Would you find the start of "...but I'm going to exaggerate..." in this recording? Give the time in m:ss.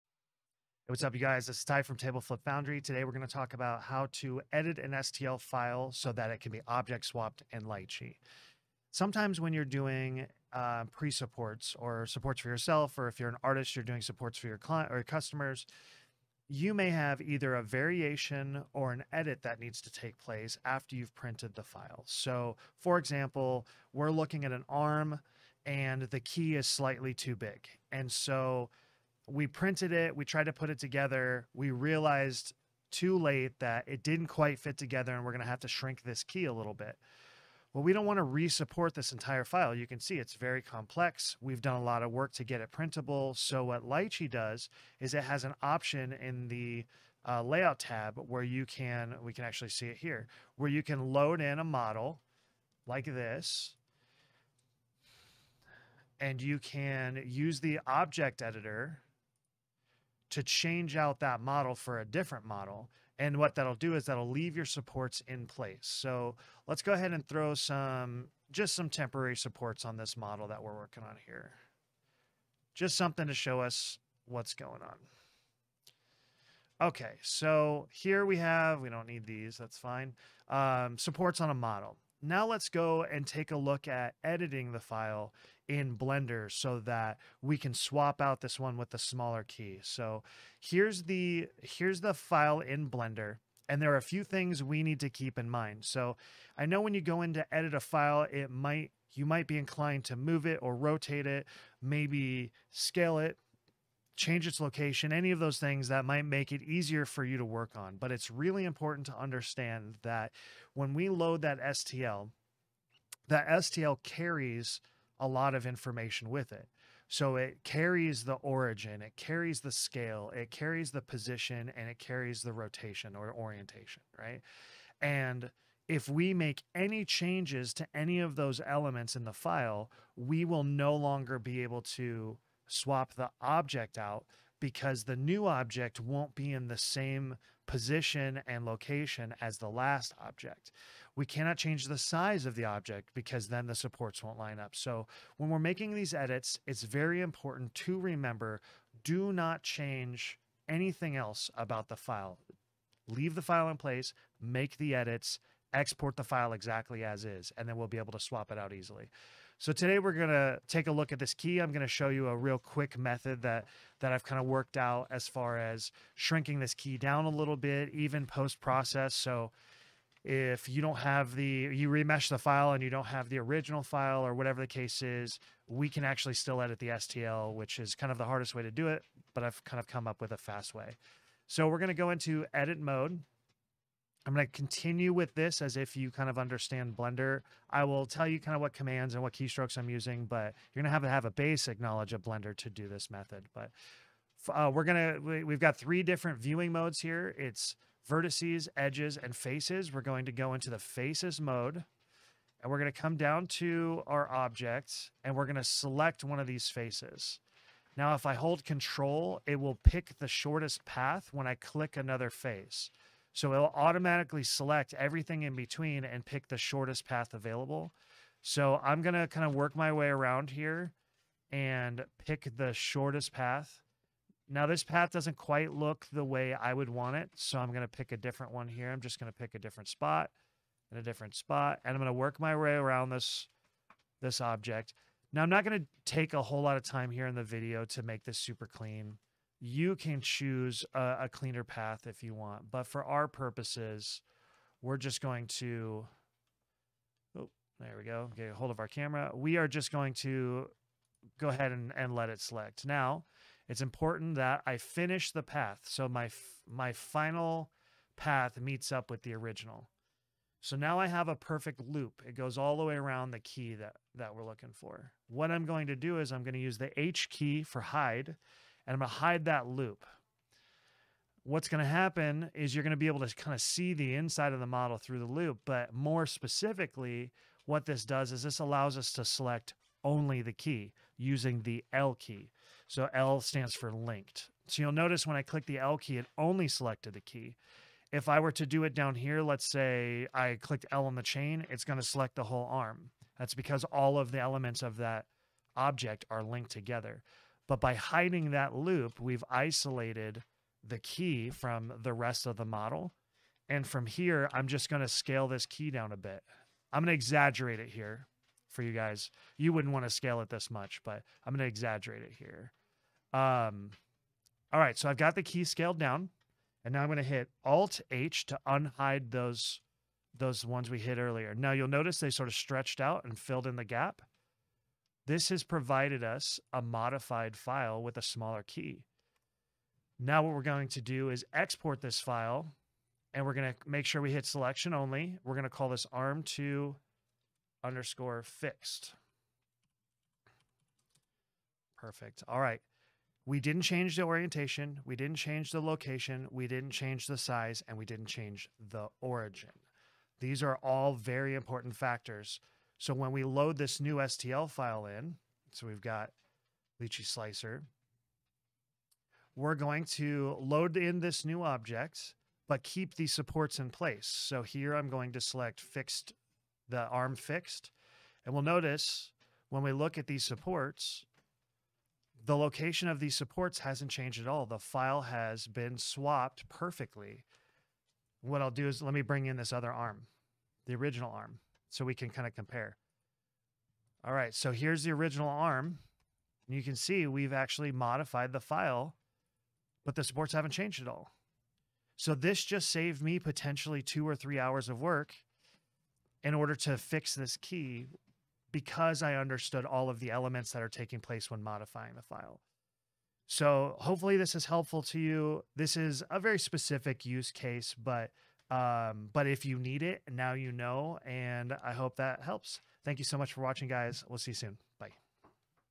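5:11.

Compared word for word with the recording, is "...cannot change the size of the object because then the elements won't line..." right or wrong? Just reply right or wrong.
wrong.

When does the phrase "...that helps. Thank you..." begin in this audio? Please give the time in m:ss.
6:52.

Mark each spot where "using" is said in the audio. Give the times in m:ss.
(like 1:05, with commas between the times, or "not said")
3:09, 4:41.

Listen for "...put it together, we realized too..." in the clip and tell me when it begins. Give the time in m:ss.
0:30.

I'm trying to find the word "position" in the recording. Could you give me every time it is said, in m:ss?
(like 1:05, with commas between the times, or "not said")
2:01, 2:17.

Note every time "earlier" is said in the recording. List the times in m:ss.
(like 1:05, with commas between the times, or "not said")
5:21.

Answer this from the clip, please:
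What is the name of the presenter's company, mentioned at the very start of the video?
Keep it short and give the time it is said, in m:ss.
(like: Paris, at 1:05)
Tableflip Foundry, at 0:01.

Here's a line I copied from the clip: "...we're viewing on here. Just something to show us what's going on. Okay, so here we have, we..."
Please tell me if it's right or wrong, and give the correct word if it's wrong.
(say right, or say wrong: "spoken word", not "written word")
wrong: "working", not "viewing".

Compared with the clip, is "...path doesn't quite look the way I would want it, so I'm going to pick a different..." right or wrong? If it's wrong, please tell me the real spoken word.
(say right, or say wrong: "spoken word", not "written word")
right.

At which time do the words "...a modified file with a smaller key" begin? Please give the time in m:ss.
5:26.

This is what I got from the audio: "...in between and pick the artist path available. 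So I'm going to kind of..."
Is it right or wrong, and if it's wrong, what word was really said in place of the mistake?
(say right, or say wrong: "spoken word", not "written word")
wrong: "shortest", not "artist".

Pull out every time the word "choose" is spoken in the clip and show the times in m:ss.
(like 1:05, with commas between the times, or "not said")
4:00.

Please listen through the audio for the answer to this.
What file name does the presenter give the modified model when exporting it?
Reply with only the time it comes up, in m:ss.
5:36.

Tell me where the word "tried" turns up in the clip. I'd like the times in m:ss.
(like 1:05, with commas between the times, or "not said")
0:30.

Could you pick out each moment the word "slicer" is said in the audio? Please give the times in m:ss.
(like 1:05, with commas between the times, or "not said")
5:57.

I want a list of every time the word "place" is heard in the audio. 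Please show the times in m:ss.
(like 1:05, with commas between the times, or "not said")
0:20, 1:05, 2:33, 6:03, 6:41.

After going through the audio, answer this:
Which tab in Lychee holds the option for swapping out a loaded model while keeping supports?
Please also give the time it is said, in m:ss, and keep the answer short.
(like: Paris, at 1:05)
Layout tab, at 0:47.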